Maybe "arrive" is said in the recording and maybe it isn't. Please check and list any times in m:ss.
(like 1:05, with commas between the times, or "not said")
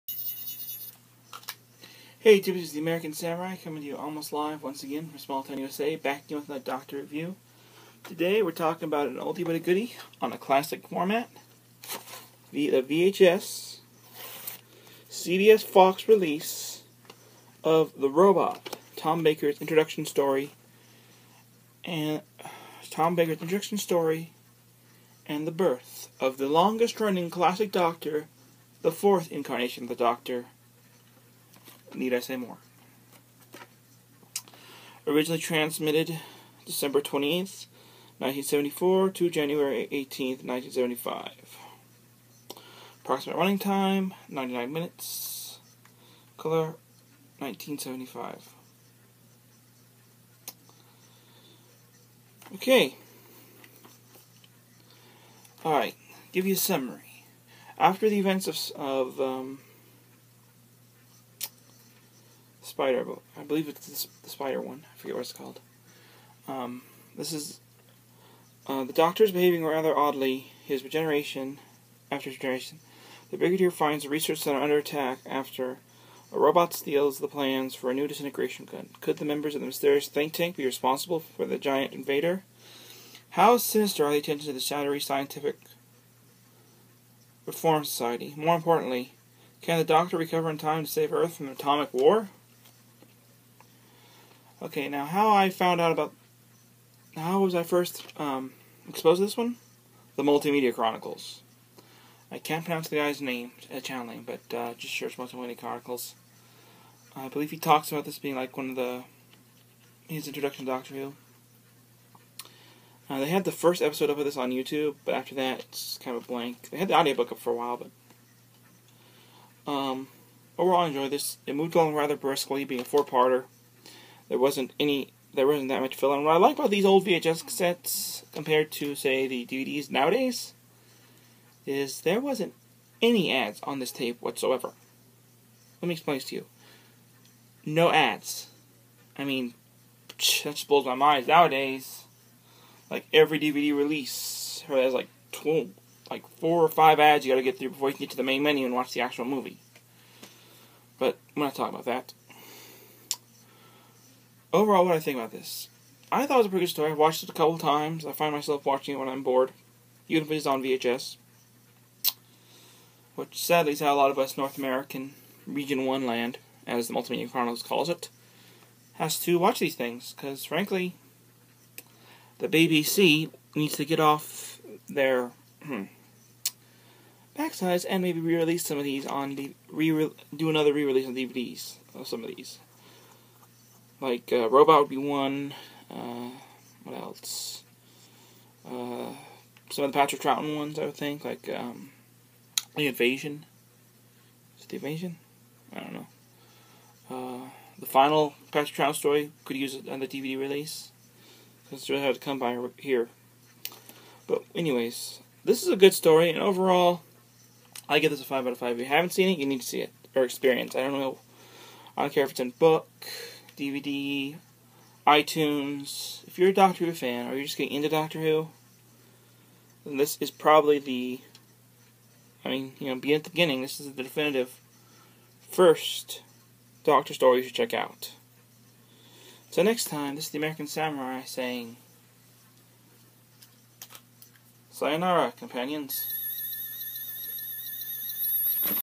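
not said.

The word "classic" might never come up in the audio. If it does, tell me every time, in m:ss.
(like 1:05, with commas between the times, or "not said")
0:10, 0:27.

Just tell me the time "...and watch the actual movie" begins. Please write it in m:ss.
2:28.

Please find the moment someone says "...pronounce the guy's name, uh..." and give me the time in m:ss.
1:42.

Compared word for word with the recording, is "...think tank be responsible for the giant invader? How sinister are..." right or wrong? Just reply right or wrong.
right.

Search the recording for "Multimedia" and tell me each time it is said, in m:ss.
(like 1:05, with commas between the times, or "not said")
1:40, 1:45, 2:46.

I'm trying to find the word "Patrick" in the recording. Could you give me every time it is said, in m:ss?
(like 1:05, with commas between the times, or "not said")
3:09, 3:18.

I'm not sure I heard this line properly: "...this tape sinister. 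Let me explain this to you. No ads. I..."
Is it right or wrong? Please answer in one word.
wrong.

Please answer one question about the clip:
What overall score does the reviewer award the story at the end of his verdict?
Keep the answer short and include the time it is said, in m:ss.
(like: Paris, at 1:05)
5 out of 5, at 3:28.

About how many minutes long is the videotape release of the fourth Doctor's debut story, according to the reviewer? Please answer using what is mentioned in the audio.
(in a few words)
99 minutes.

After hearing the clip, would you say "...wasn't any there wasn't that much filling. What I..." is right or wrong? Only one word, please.
right.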